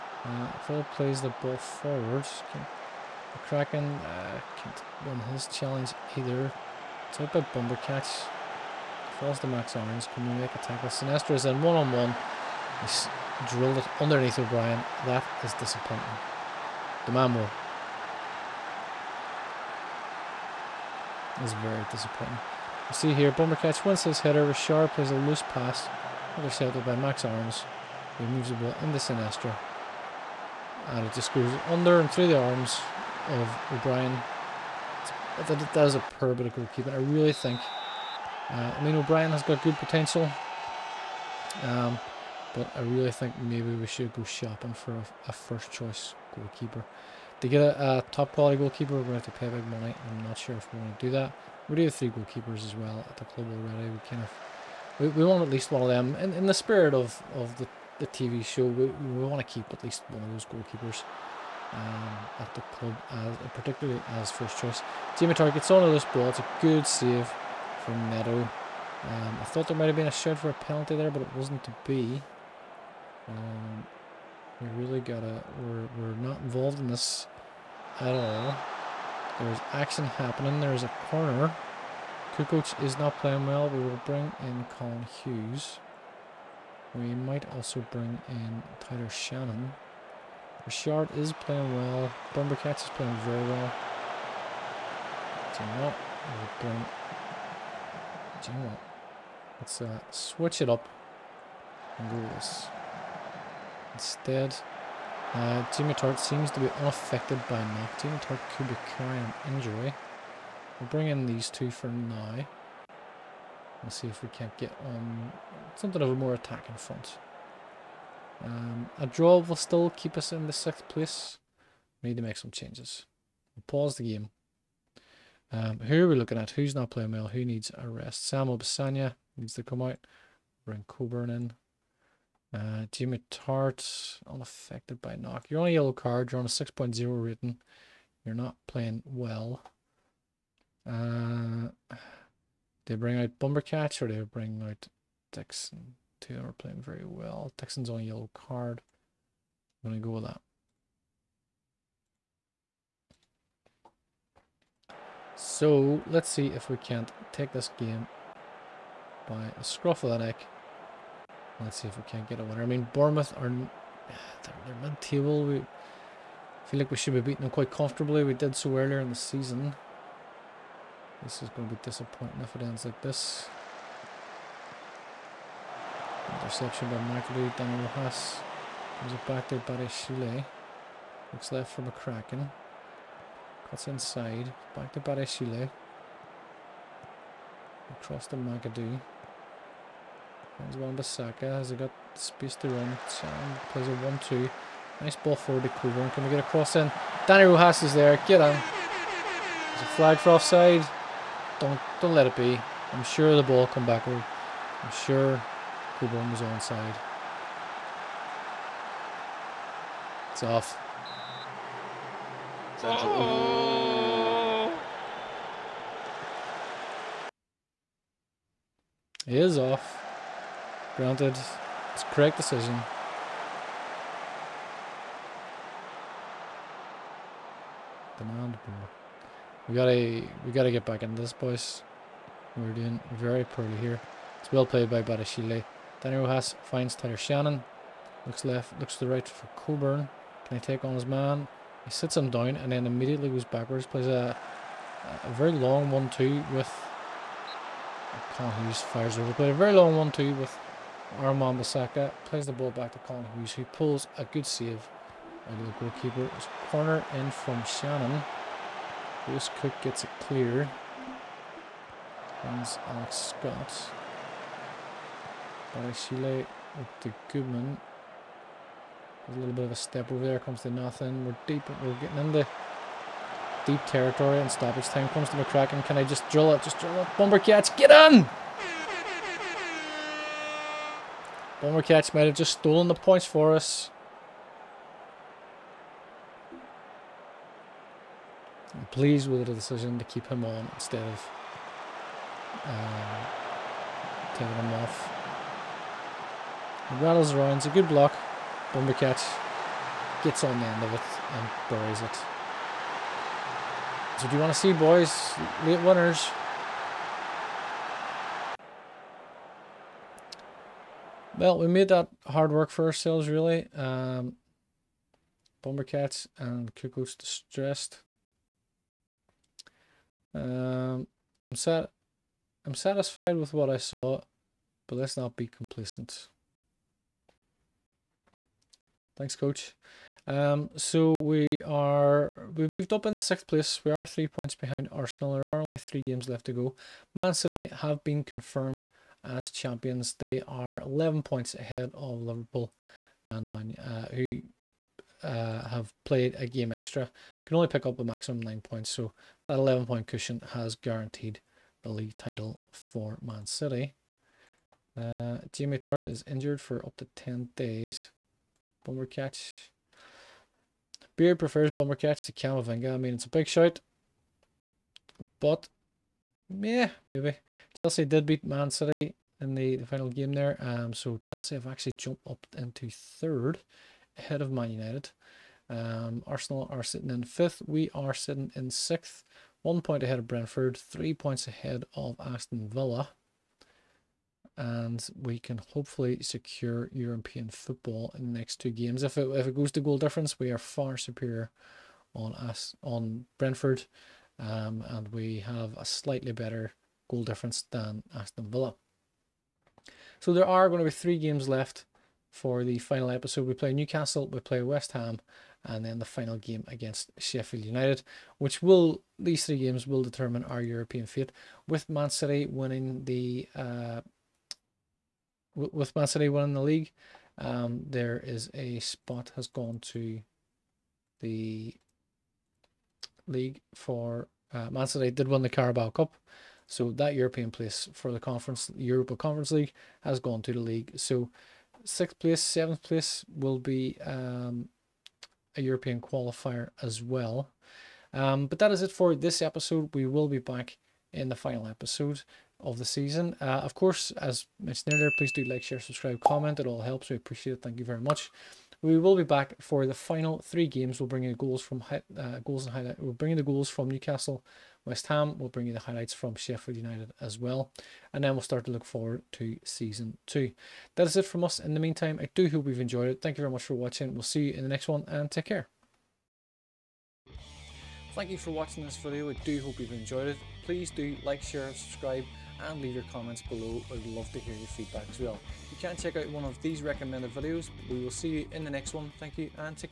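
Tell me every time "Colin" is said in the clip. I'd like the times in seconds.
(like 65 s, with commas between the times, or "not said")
84 s, 248 s, 253 s.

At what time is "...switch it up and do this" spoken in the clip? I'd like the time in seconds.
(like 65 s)
100 s.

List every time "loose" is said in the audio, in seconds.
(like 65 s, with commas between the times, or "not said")
25 s.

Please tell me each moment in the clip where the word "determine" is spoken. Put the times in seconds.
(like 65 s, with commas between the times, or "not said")
410 s.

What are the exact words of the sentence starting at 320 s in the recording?
Um, I'm, sat I'm satisfied with what I saw, but let's not be complacent.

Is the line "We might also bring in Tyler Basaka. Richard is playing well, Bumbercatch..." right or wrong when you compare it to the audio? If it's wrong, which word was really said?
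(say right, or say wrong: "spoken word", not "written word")
wrong: "Shannon", not "Basaka".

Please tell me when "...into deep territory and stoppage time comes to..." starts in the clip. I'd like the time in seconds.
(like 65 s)
272 s.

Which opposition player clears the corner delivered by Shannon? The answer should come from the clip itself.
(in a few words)
Lewis Cook.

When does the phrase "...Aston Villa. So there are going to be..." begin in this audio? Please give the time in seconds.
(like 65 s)
398 s.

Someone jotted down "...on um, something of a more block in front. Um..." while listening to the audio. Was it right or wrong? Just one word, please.
wrong.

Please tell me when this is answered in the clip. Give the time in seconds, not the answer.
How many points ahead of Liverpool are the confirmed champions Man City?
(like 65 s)
340 s.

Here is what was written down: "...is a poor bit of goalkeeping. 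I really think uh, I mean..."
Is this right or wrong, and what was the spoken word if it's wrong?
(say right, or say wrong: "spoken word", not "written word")
right.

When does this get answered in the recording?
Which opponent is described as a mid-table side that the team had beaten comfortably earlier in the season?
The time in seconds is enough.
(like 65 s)
162 s.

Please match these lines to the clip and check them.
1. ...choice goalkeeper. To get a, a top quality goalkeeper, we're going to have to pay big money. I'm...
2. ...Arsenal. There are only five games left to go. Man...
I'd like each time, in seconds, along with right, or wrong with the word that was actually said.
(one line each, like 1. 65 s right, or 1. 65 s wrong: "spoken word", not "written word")
1. 45 s right
2. 334 s wrong: "three", not "five".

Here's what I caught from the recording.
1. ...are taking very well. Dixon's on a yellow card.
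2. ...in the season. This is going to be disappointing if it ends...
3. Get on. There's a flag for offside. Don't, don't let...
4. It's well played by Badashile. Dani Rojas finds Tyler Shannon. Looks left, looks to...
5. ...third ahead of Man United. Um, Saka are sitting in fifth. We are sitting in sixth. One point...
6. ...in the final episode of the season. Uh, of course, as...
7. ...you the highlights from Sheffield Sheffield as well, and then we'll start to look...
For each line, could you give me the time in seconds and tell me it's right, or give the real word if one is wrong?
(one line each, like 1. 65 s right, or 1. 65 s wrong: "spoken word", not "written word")
1. 146 s wrong: "playing", not "taking"
2. 169 s right
3. 198 s right
4. 234 s right
5. 372 s wrong: "Arsenal", not "Saka"
6. 441 s right
7. 455 s wrong: "United", not "Sheffield".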